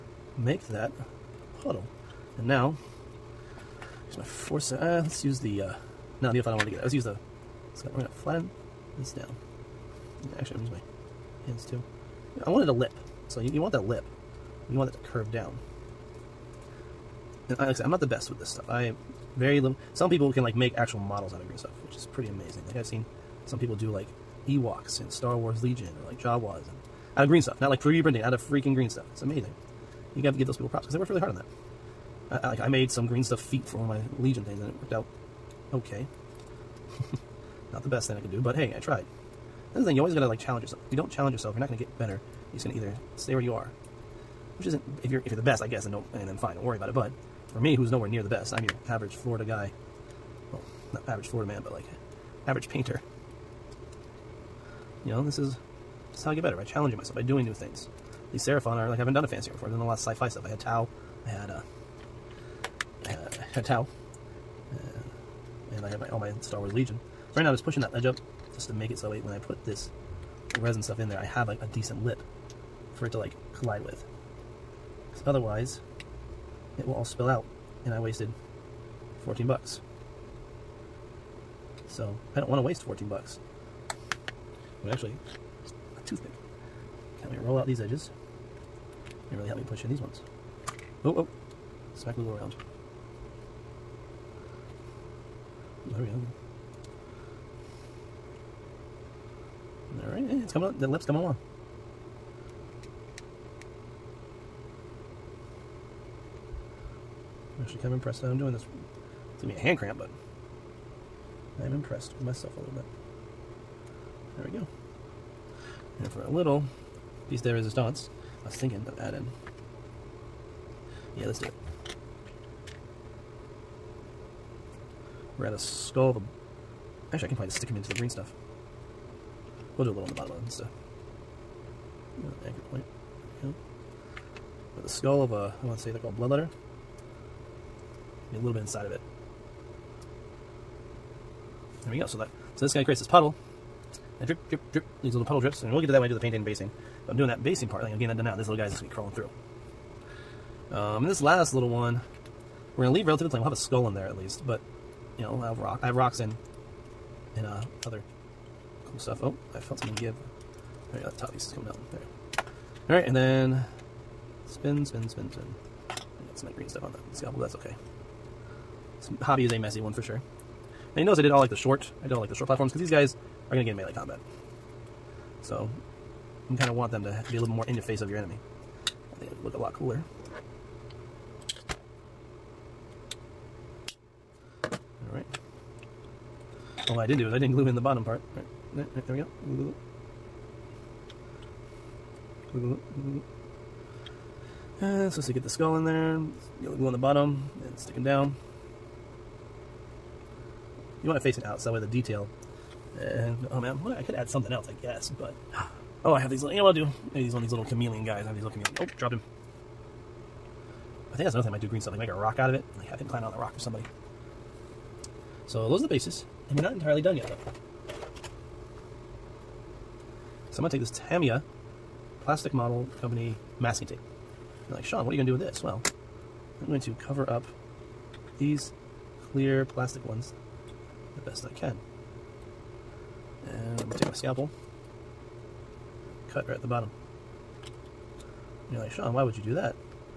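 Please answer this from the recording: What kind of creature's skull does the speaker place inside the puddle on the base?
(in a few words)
Bloodletter.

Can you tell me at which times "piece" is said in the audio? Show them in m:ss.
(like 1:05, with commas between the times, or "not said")
1:57, 2:41.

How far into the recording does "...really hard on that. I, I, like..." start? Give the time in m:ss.
0:31.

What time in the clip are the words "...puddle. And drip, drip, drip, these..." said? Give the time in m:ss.
2:23.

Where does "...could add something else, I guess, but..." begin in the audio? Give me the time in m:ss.
3:24.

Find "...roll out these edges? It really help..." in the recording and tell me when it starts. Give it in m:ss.
1:27.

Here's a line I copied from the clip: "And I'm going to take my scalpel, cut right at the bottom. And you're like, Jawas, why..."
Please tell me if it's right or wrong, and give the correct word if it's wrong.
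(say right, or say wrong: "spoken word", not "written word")
wrong: "Sean", not "Jawas".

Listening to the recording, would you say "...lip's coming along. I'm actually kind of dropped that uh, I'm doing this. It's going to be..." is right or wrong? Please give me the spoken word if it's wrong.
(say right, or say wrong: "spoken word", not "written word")
wrong: "impressed", not "dropped".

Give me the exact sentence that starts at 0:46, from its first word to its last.
But for me, who's nowhere near the best, I'm your average Florida guy.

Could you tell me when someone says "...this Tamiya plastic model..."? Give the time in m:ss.
3:40.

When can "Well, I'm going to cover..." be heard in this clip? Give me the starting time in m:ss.
3:45.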